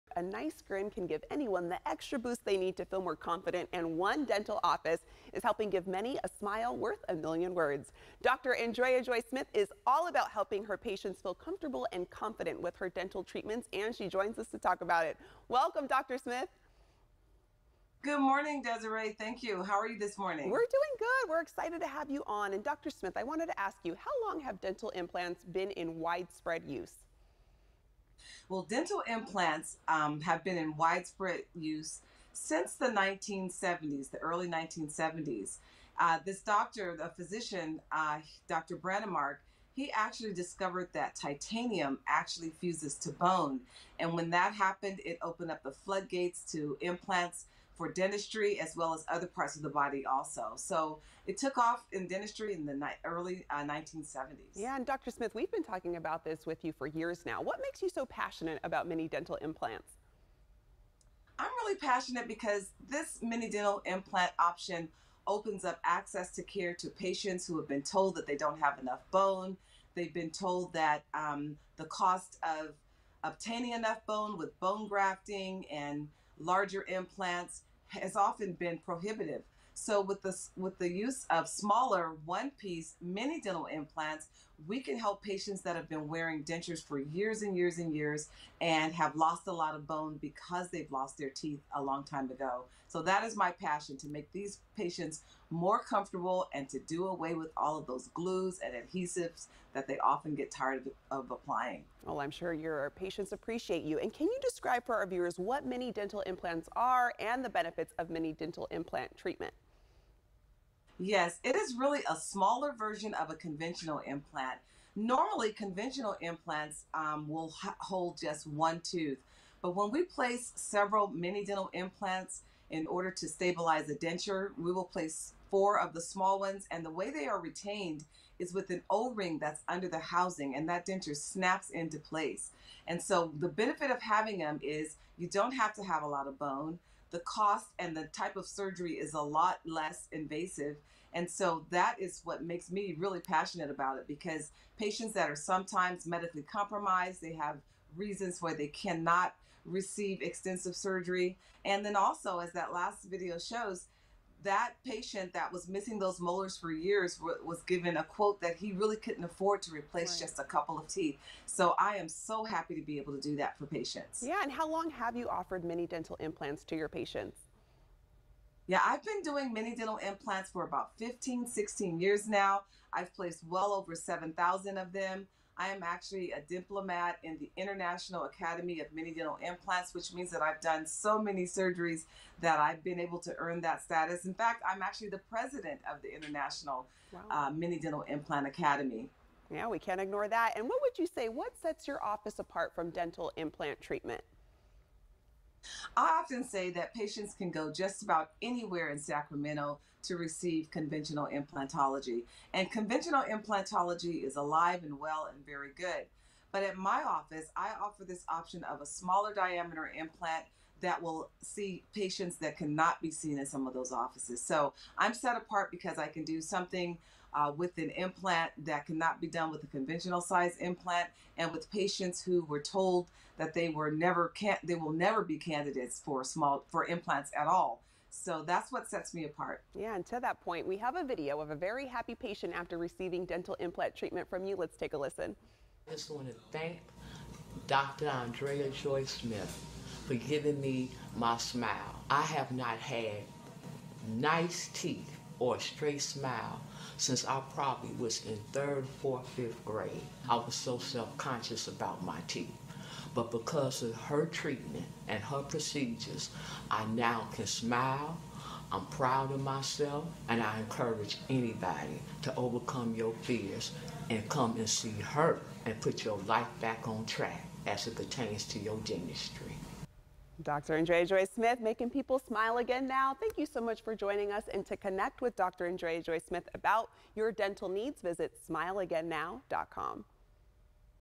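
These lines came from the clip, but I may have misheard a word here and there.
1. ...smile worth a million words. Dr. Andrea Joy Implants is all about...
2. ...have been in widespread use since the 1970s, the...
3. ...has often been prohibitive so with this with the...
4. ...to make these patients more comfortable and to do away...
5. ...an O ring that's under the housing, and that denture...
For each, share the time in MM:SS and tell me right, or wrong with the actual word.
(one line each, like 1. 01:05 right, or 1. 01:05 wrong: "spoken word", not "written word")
1. 00:06 wrong: "Smith", not "Implants"
2. 00:30 right
3. 01:17 right
4. 01:33 right
5. 02:08 right.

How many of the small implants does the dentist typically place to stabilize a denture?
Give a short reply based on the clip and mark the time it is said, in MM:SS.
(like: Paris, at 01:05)
4, at 02:05.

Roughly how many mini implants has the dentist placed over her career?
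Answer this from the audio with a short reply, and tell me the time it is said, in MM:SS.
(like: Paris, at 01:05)
Over 7,000, at 02:53.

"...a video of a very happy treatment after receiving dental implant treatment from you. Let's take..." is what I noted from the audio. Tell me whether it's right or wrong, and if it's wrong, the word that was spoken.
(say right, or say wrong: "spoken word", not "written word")
wrong: "patient", not "treatment".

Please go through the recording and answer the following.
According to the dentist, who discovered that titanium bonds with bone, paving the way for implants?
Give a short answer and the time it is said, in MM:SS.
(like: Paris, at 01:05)
Dr. Brånemark, at 00:38.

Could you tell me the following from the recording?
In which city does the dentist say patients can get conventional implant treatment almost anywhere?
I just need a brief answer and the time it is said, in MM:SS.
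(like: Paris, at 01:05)
Sacramento, at 03:18.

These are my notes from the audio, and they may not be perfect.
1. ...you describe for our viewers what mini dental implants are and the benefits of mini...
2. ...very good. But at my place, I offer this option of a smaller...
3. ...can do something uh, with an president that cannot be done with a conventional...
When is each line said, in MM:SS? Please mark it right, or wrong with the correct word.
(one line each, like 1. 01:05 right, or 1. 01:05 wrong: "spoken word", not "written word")
1. 01:44 right
2. 03:25 wrong: "office", not "place"
3. 03:36 wrong: "implant", not "president".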